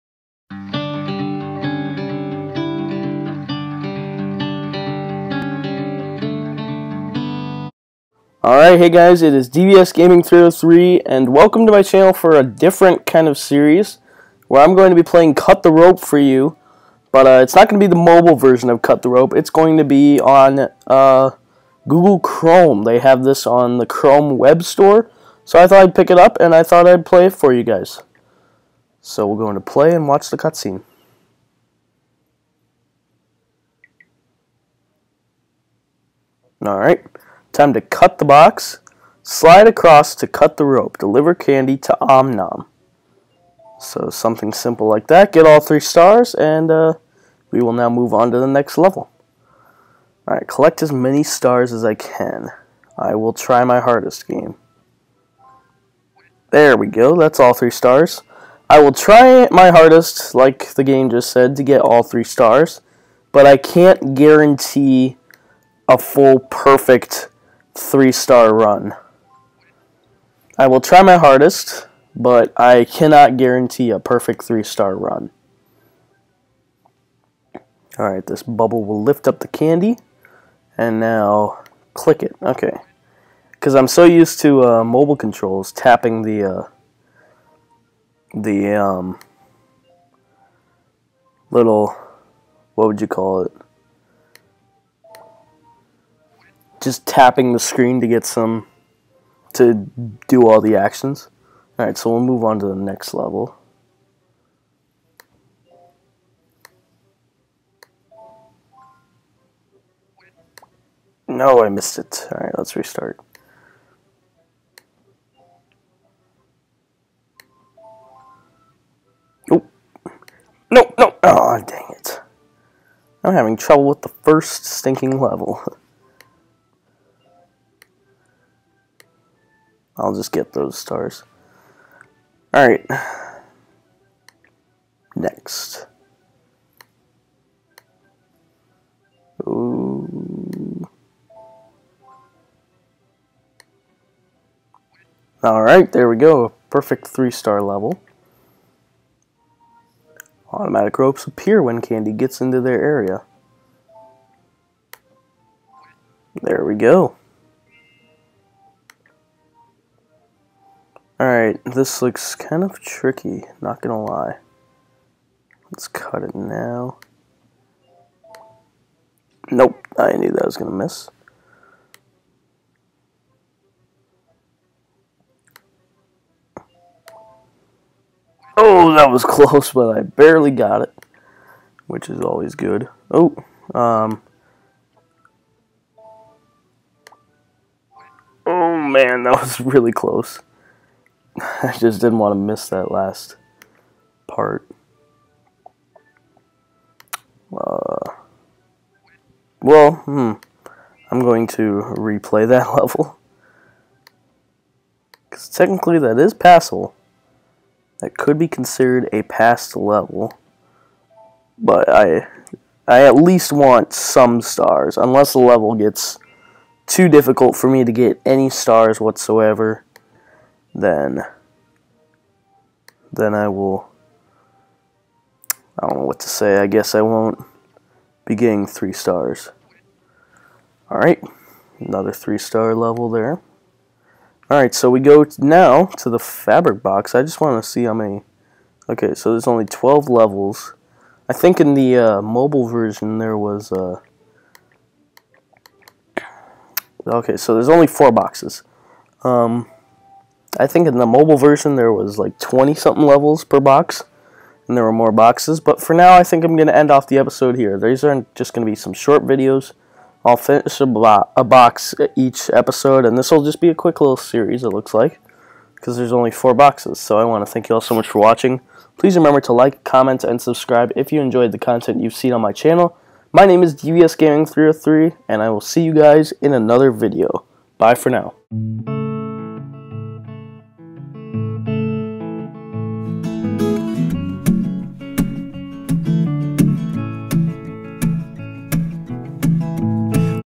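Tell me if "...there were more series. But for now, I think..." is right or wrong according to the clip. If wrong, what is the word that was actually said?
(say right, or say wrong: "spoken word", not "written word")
wrong: "boxes", not "series".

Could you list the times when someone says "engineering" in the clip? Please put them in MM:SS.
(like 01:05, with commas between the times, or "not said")
not said.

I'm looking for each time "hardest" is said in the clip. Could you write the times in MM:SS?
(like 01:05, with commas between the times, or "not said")
00:53, 00:59, 01:11.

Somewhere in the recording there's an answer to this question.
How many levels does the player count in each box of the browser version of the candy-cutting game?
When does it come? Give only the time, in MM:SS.
03:59.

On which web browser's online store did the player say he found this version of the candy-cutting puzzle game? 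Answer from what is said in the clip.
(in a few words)
Google Chrome.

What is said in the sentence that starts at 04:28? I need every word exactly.
Please remember to like, comment, and subscribe if you enjoyed the content you've seen on my channel.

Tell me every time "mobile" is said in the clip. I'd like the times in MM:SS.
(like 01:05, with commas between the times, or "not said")
00:17, 01:24, 04:02, 04:11.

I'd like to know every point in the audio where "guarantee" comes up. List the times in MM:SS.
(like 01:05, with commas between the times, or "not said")
01:04, 01:13.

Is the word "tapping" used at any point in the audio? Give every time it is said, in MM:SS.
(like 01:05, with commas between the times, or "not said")
01:25, 01:37.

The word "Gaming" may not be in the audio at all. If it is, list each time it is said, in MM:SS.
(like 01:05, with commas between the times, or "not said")
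00:09, 04:34.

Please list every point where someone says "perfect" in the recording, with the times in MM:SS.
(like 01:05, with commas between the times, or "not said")
01:06, 01:13, 02:26.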